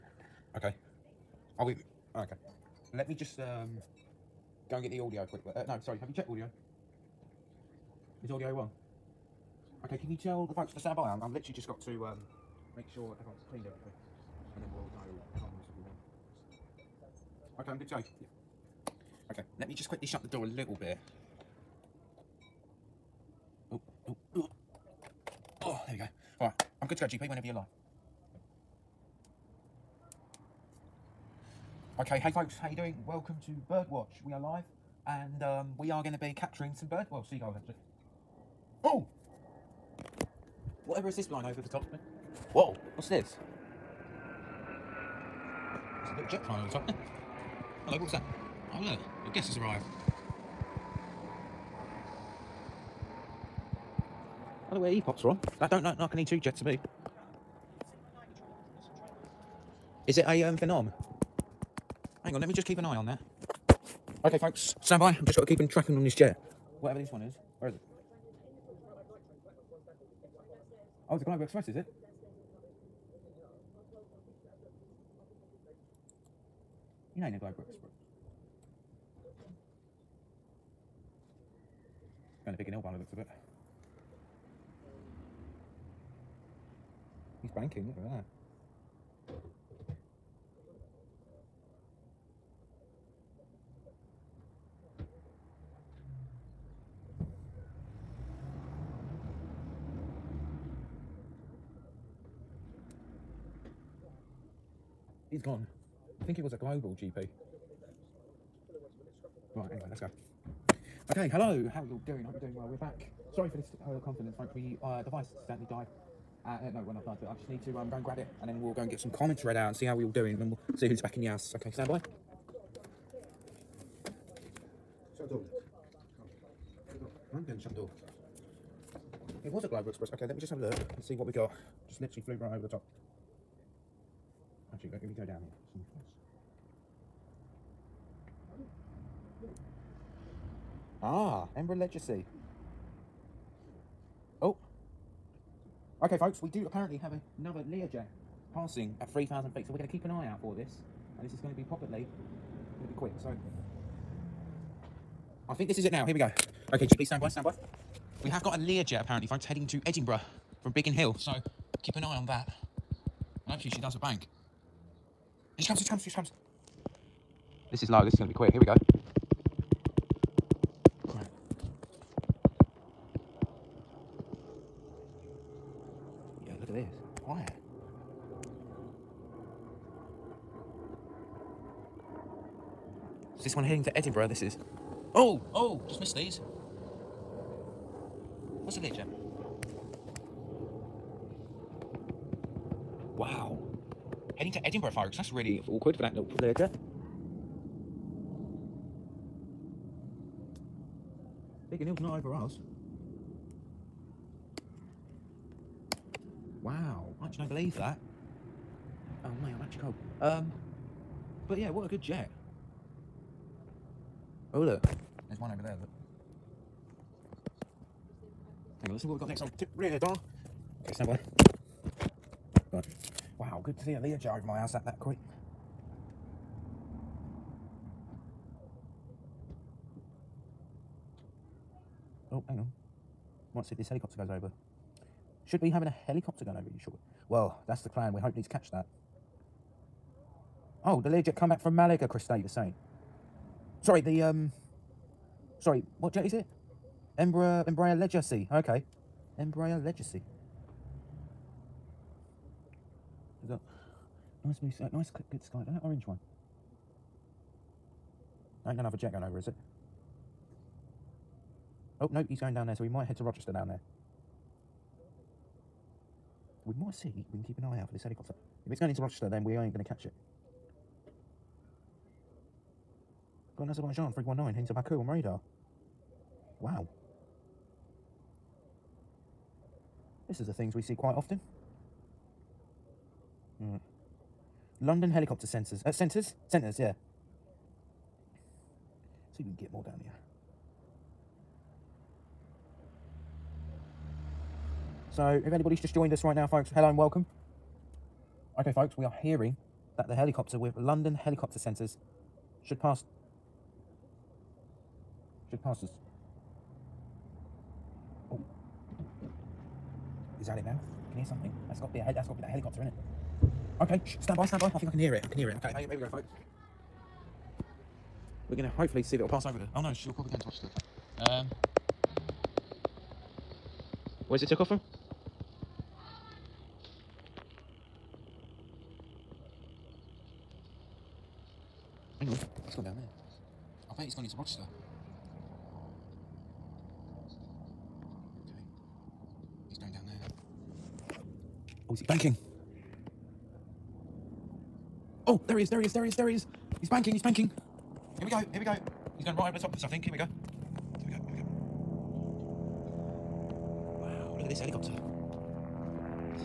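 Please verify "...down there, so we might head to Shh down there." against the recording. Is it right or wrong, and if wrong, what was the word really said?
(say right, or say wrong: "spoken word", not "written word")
wrong: "Rochester", not "Shh".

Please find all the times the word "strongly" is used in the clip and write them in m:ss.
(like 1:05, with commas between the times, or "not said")
not said.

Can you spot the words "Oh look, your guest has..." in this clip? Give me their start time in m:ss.
0:48.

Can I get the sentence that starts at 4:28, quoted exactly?
If it's going into Rochester, then we ain't going to catch it.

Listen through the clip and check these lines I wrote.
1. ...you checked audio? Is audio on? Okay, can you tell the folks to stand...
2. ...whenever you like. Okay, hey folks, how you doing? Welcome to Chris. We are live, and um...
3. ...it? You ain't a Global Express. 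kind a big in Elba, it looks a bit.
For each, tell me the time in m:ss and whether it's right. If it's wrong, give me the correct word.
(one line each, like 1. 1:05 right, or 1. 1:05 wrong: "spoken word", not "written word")
1. 0:06 right
2. 0:27 wrong: "Birdwatch", not "Chris"
3. 1:11 right.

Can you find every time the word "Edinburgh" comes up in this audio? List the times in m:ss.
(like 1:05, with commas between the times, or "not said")
2:39, 3:03, 3:14.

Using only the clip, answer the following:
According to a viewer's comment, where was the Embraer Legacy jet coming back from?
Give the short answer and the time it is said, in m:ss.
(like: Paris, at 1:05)
Malaga, at 4:01.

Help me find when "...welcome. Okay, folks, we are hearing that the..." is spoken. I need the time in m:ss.
4:56.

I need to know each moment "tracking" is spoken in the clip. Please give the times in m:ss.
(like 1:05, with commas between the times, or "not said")
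1:05.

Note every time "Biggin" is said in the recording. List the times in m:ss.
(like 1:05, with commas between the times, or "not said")
2:40, 3:21.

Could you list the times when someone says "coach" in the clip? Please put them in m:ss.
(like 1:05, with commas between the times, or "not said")
not said.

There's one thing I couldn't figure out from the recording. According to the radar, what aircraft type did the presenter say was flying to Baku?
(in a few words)
319.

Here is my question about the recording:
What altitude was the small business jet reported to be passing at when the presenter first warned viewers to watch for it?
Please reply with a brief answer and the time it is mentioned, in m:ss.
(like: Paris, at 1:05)
3,000 feet, at 2:29.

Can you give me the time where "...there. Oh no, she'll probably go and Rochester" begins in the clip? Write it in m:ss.
5:19.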